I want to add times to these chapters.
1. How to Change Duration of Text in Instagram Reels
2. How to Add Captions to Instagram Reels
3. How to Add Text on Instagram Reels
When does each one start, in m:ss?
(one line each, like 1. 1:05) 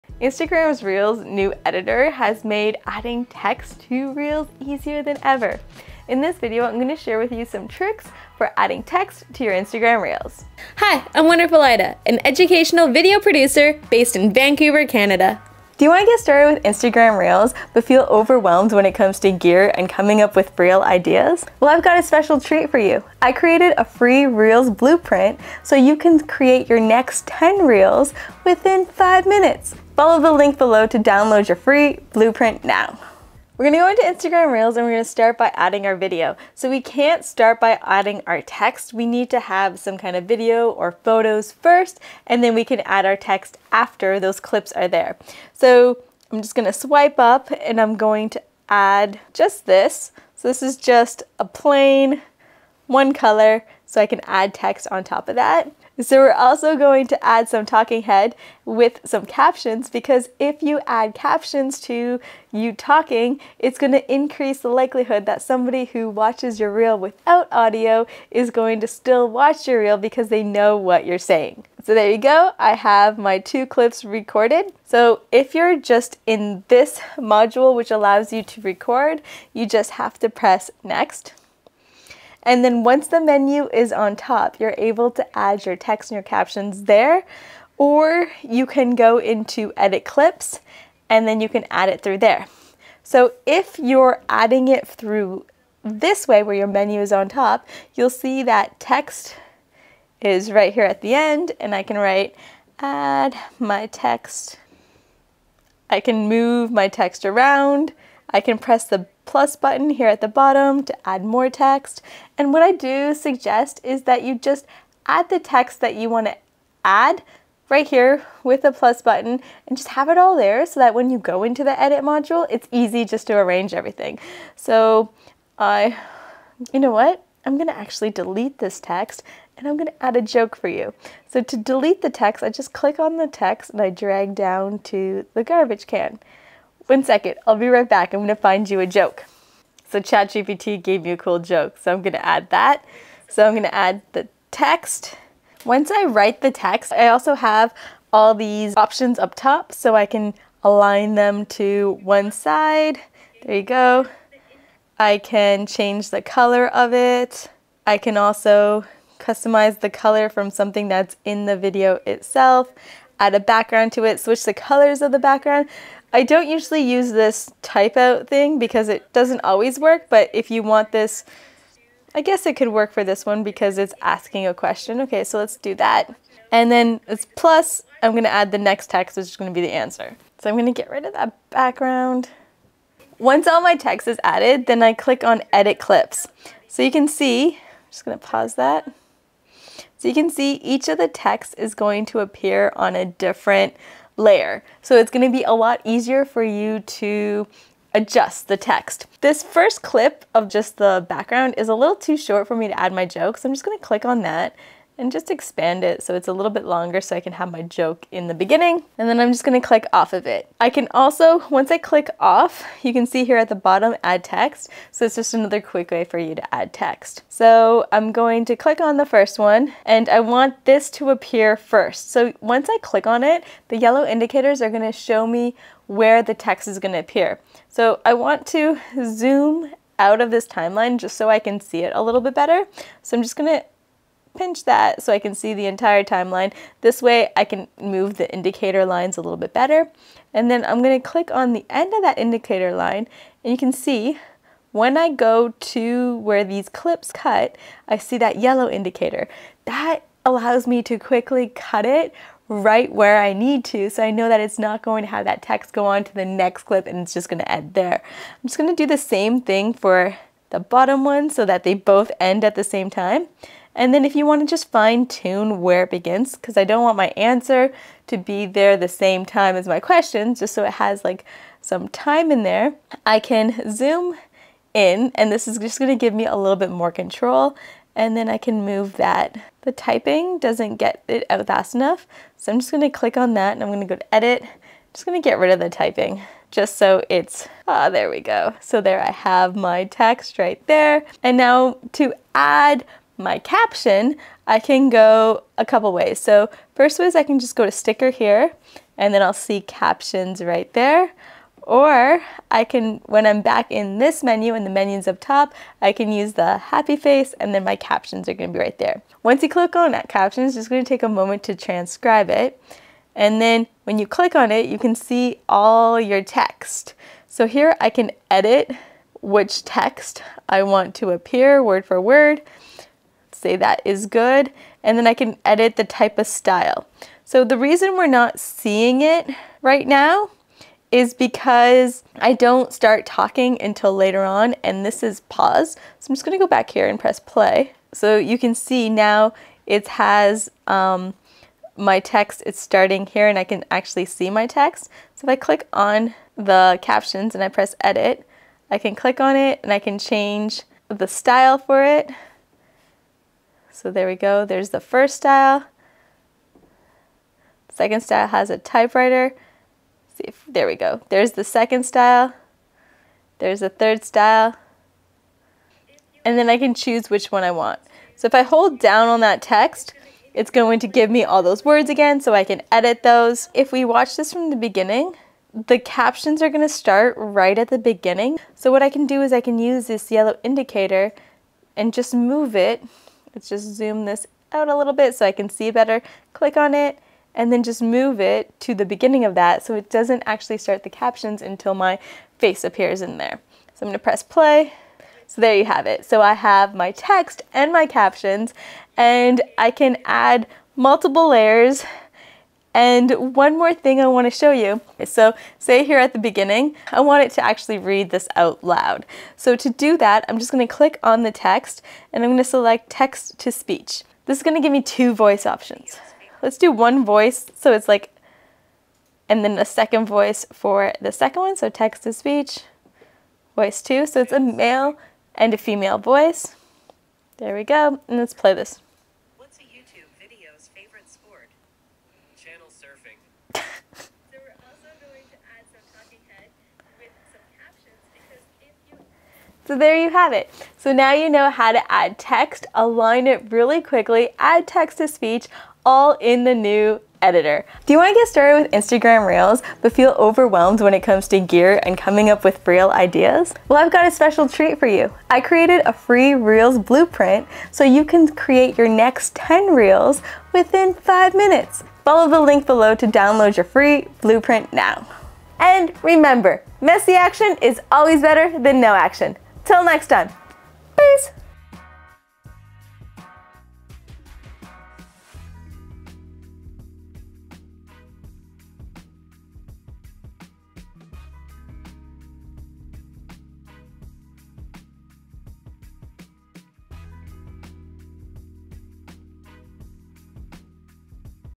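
1. 3:10
2. 4:53
3. 0:34.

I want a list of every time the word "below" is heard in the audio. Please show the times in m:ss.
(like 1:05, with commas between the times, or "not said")
0:30, 7:42.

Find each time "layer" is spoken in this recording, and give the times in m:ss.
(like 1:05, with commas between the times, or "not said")
3:14, 6:41.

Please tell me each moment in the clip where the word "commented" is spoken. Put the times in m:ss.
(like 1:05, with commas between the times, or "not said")
not said.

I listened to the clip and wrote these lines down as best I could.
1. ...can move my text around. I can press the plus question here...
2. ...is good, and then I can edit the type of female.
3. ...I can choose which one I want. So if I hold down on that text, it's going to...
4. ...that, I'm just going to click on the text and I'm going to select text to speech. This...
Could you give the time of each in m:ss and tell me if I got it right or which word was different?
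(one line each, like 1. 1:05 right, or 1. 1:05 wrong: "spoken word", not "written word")
1. 1:45 wrong: "button", not "question"
2. 5:23 wrong: "style", not "female"
3. 6:06 right
4. 6:49 right.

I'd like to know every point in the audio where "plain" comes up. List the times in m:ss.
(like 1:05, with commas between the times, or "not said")
0:51.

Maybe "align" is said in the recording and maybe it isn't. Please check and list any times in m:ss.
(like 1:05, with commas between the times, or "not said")
2:30, 7:22.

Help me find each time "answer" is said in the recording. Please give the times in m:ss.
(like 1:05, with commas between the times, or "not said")
2:59, 4:27.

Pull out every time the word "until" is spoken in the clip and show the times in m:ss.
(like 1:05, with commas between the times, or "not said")
5:33, 6:31.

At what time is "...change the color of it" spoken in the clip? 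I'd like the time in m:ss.
2:35.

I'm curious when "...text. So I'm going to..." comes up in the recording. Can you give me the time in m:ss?
3:36.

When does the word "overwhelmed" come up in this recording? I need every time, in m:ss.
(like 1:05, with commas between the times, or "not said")
0:18, 7:30.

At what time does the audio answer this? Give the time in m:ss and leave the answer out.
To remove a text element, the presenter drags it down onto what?
2:15.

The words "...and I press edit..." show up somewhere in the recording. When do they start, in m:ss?
5:47.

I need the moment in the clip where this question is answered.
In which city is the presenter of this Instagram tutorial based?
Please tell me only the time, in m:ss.
0:14.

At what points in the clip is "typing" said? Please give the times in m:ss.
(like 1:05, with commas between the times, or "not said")
4:39, 4:45.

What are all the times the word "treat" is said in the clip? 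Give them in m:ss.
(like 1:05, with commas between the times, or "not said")
0:22, 7:34.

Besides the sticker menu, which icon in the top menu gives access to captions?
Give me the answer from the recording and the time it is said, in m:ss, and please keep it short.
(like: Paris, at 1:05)
the happy face, at 5:06.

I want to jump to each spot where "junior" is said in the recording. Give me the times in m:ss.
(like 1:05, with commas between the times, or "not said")
not said.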